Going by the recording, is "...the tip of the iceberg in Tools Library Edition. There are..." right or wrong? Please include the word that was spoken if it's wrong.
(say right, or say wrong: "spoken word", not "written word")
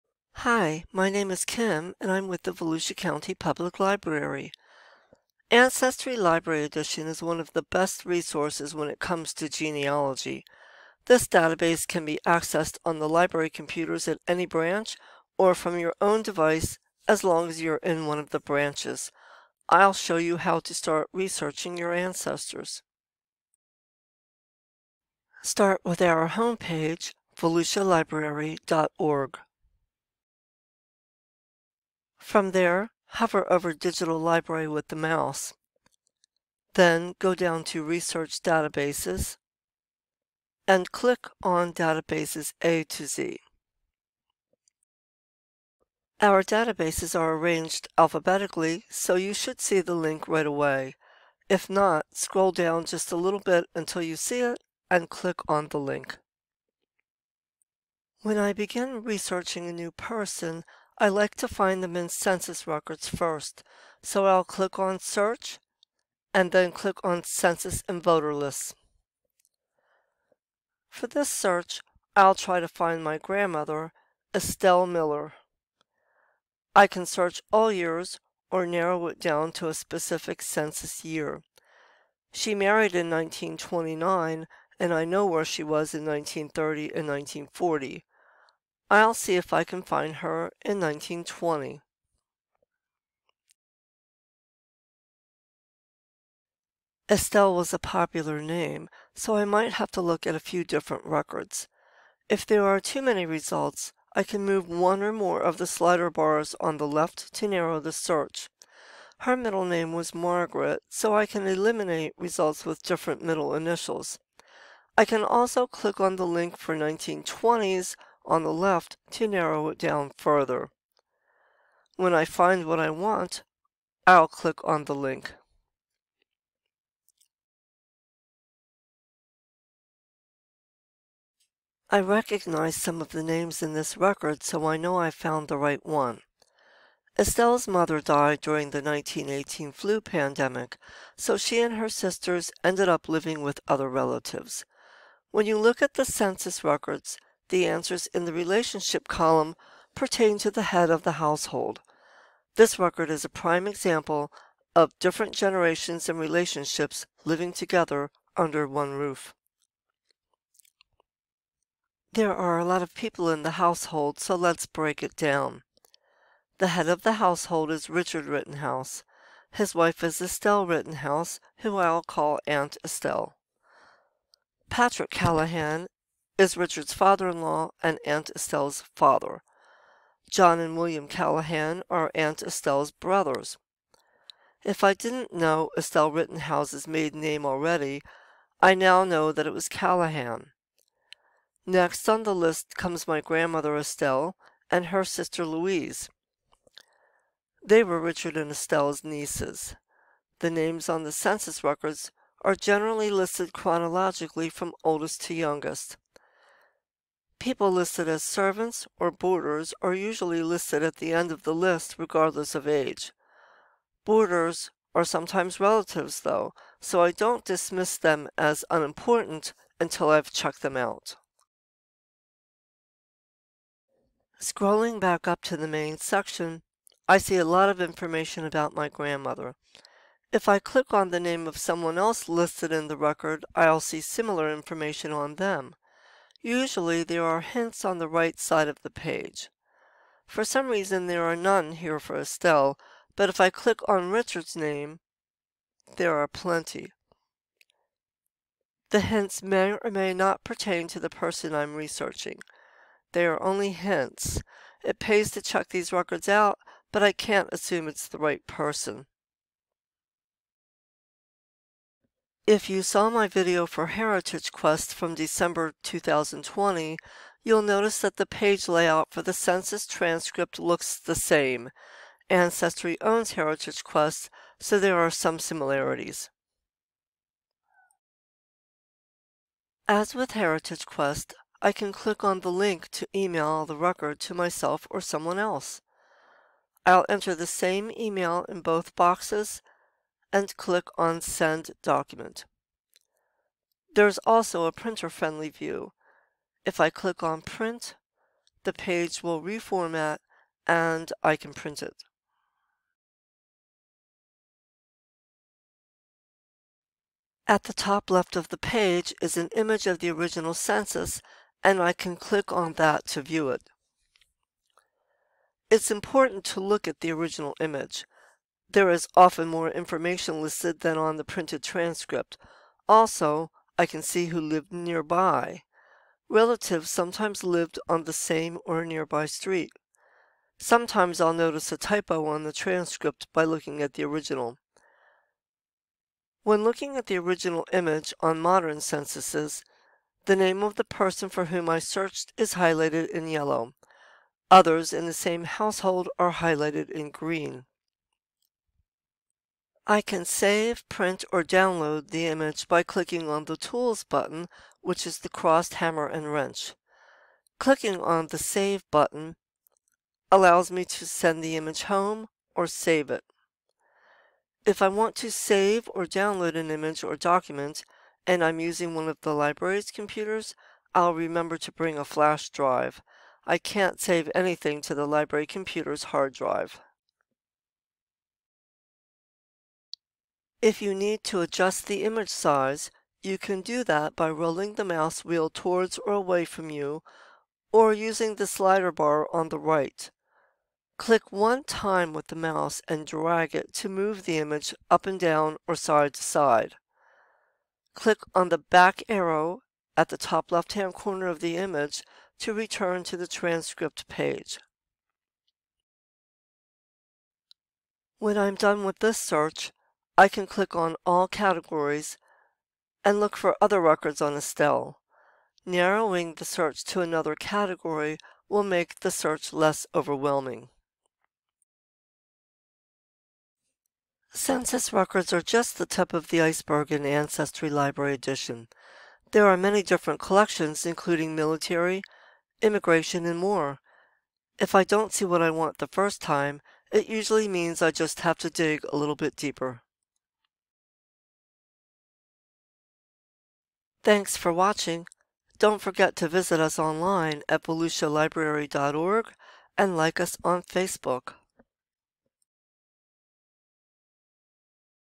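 wrong: "Ancestry", not "Tools".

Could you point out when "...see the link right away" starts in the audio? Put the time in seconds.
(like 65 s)
49 s.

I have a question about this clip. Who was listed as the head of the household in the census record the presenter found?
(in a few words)
Richard Rittenhouse.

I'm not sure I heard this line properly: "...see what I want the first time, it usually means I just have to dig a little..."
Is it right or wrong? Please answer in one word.
right.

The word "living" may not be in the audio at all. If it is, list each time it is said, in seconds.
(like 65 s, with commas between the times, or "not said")
143 s, 157 s.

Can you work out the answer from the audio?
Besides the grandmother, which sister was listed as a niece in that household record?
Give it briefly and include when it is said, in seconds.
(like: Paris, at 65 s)
Louise, at 195 s.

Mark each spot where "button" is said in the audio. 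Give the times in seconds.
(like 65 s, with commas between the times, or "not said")
354 s, 358 s.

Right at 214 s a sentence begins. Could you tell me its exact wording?
Boarders are sometimes relatives though, so I don't dismiss them as unimportant until I've checked them out.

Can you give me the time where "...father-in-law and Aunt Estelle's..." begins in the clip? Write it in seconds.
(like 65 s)
176 s.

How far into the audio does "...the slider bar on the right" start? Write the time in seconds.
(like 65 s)
388 s.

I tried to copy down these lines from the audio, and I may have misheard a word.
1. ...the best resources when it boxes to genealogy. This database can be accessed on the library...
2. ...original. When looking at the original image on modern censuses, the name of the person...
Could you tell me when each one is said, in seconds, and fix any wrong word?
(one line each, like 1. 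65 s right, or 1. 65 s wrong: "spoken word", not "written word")
1. 7 s wrong: "comes", not "boxes"
2. 334 s right.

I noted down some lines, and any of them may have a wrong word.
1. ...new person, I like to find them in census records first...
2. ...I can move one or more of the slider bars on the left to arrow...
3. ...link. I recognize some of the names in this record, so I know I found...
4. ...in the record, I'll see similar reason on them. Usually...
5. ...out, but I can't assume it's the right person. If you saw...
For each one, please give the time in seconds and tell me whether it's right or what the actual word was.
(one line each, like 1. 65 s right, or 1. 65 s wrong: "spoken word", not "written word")
1. 59 s right
2. 104 s wrong: "narrow", not "arrow"
3. 124 s right
4. 232 s wrong: "information", not "reason"
5. 256 s right.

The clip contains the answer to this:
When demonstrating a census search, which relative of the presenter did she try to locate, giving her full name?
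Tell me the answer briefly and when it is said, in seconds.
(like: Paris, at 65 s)
Estelle Miller, at 74 s.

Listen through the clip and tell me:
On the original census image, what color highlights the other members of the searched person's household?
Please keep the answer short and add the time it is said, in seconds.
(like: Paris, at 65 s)
green, at 347 s.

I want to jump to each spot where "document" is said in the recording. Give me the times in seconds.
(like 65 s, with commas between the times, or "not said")
291 s, 367 s.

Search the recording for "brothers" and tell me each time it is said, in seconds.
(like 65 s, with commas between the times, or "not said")
182 s.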